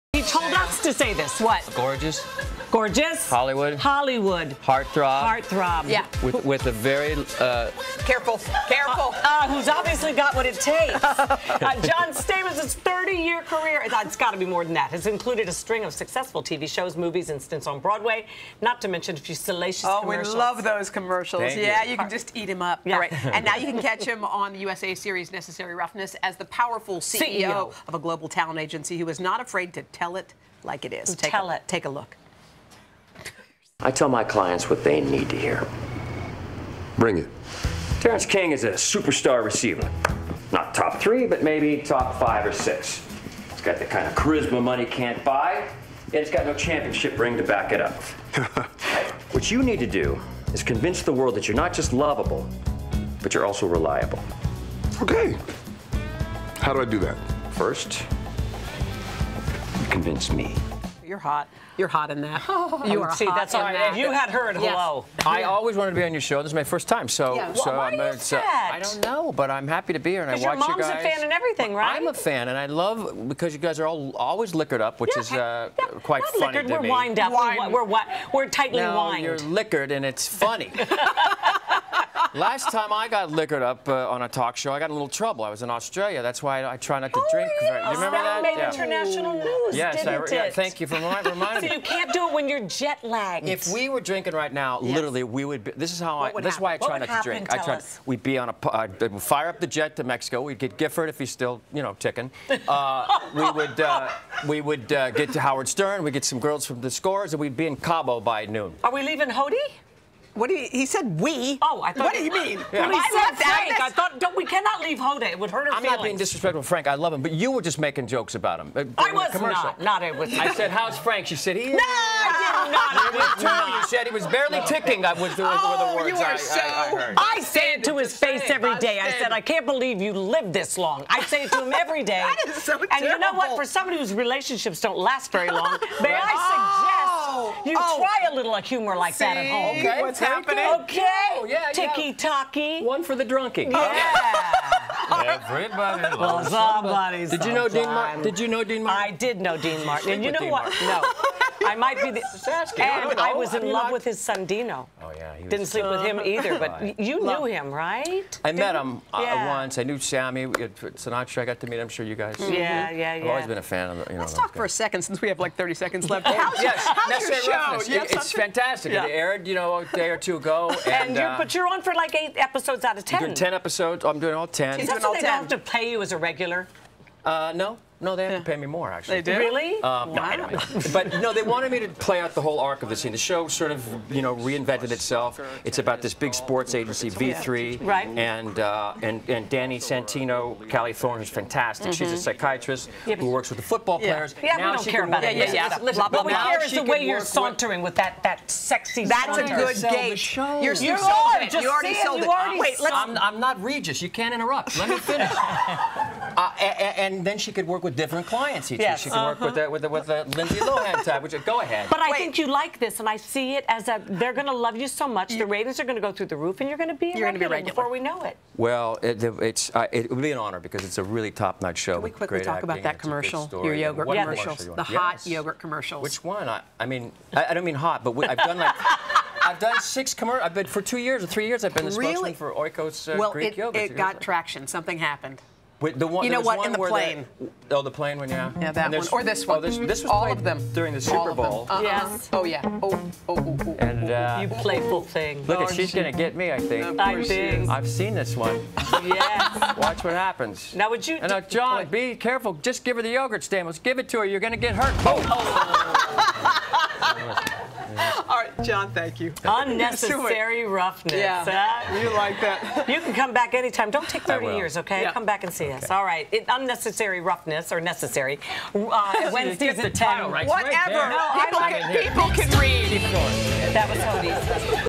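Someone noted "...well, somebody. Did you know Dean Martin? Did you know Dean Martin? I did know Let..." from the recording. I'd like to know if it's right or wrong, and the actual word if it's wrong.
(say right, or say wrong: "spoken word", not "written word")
wrong: "Dean", not "Let".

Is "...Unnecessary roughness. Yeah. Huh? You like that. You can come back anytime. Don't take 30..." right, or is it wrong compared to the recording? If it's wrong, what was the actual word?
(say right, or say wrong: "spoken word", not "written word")
right.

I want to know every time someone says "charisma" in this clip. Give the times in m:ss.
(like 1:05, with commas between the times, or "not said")
0:44.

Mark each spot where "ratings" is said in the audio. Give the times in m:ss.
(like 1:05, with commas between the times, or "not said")
3:35.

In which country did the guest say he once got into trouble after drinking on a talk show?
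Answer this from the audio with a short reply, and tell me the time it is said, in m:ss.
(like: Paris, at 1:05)
Australia, at 1:25.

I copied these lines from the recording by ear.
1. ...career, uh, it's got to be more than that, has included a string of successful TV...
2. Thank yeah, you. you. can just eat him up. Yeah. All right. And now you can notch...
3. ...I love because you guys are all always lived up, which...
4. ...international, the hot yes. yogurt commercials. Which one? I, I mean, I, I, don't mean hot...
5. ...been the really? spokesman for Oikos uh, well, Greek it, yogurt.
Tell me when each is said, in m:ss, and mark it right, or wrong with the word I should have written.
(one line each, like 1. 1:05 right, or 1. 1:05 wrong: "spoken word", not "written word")
1. 0:13 right
2. 0:21 wrong: "catch", not "notch"
3. 1:12 wrong: "liquored", not "lived"
4. 3:44 wrong: "commercial", not "international"
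5. 3:51 right.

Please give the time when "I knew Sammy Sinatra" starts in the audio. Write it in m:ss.
2:39.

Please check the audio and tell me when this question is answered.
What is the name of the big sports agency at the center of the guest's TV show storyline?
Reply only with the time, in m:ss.
3:07.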